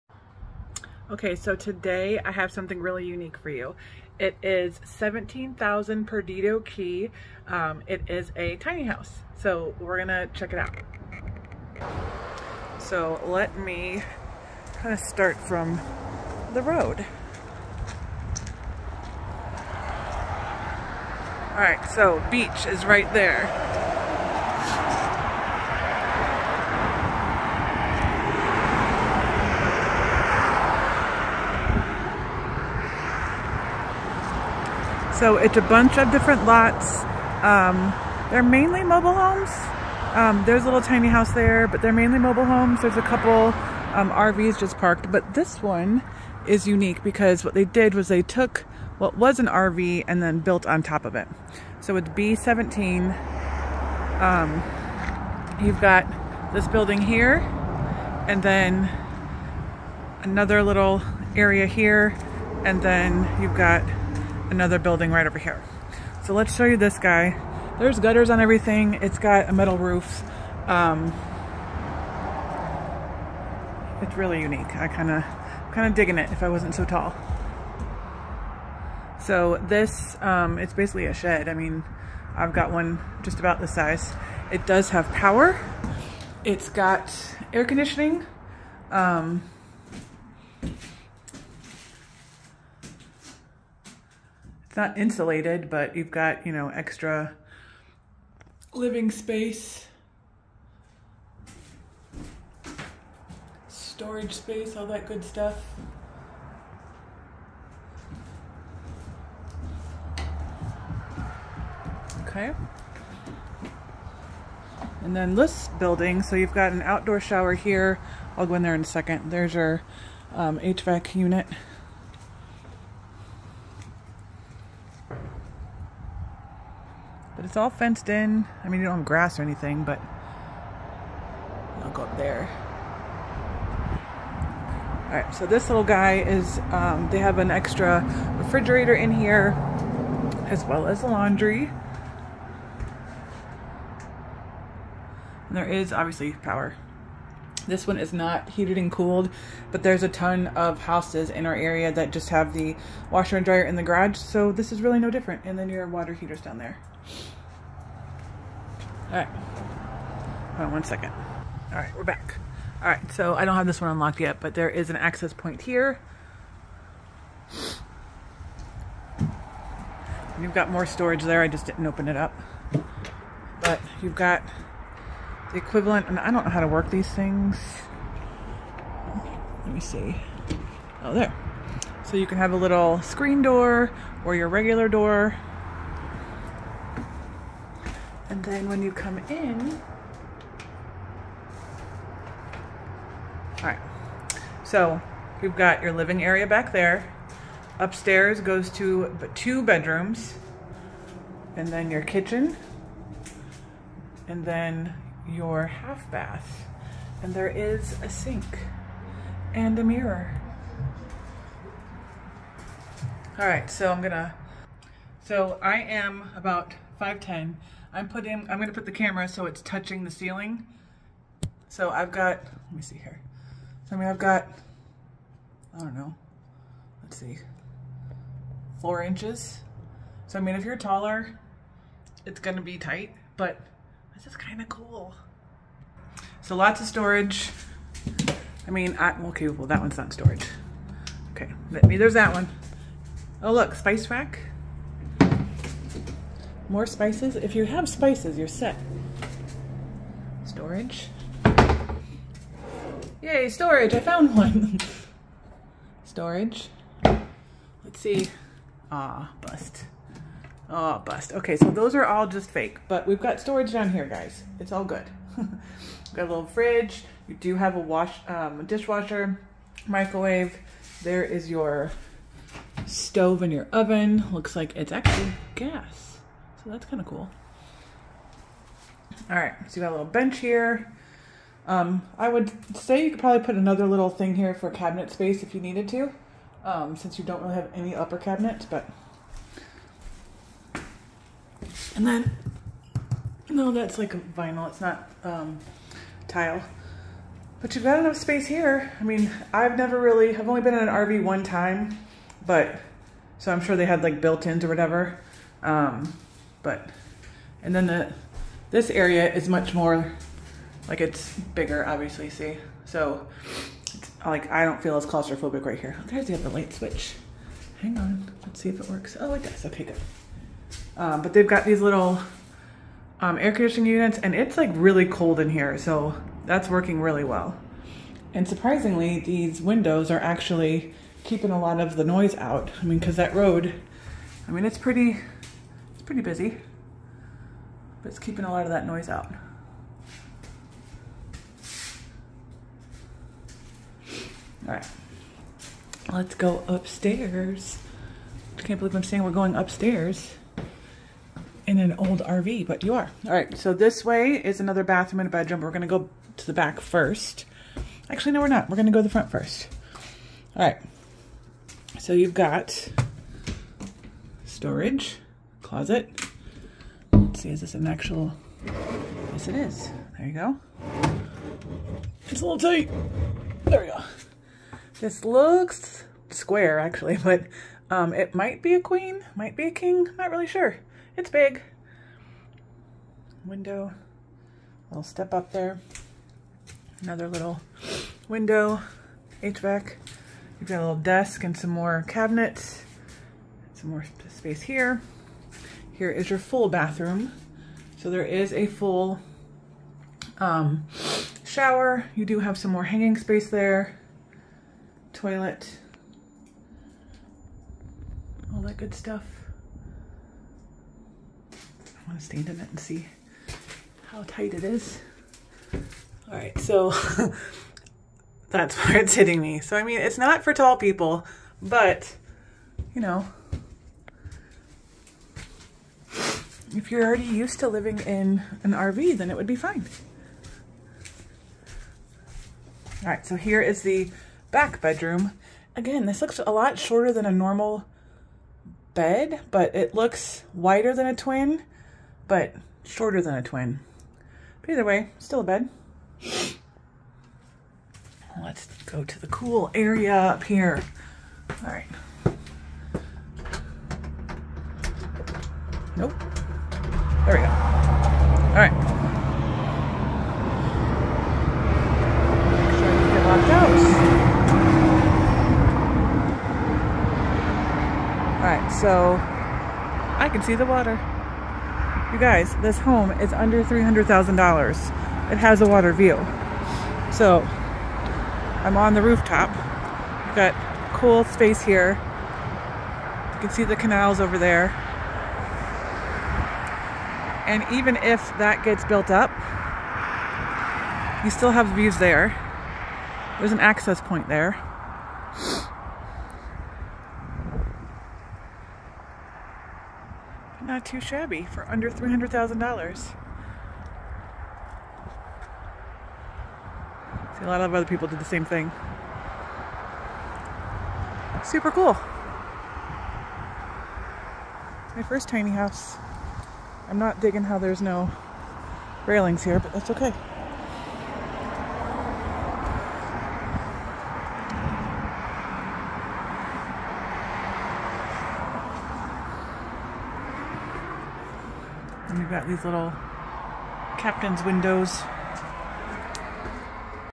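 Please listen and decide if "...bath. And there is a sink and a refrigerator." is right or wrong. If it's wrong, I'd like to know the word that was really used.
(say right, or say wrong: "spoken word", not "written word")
wrong: "mirror", not "refrigerator".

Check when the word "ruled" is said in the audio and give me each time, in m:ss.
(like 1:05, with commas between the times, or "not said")
not said.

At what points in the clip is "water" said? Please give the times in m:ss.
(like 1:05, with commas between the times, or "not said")
2:35, 7:50, 7:55.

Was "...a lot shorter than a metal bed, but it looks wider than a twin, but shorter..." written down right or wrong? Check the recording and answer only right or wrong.
wrong.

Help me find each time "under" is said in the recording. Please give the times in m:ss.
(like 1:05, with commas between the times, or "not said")
7:53, 8:21.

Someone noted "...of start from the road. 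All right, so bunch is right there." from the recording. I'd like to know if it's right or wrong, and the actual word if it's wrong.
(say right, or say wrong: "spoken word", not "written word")
wrong: "beach", not "bunch".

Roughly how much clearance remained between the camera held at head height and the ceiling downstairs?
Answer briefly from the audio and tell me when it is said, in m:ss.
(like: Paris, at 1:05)
4 inches, at 3:48.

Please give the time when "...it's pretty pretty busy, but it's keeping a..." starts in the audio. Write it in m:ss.
5:34.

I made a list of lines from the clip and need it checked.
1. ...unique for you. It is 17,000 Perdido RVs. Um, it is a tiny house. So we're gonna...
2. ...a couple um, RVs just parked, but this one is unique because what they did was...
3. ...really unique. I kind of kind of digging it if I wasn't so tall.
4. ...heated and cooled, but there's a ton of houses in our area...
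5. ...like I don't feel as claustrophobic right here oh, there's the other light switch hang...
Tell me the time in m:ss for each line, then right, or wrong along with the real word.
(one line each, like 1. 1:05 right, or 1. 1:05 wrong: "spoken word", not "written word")
1. 0:03 wrong: "Key", not "RVs"
2. 0:42 right
3. 1:14 right
4. 2:28 right
5. 5:14 right.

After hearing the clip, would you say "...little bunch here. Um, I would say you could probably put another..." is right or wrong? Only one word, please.
wrong.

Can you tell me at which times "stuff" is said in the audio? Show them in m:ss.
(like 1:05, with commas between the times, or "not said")
1:45, 6:48.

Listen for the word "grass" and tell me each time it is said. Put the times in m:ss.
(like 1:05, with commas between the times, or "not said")
2:09.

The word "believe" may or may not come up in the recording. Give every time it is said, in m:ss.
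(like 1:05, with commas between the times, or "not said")
5:48.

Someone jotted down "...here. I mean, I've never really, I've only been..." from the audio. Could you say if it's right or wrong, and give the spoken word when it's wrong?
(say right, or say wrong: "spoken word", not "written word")
right.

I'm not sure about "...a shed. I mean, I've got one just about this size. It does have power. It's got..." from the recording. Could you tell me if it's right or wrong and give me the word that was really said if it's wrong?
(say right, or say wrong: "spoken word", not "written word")
right.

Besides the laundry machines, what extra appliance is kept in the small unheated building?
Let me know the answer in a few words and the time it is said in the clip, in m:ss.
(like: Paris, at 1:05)
Refrigerator, at 2:17.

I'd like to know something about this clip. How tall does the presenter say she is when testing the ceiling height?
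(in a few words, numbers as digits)
5'10".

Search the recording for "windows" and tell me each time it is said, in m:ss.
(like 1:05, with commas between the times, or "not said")
5:29, 6:23, 6:28, 8:54.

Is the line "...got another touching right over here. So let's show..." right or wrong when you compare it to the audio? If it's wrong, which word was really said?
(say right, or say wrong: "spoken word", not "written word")
wrong: "building", not "touching".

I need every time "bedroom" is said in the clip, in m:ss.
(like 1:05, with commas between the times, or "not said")
3:19, 5:55, 7:14.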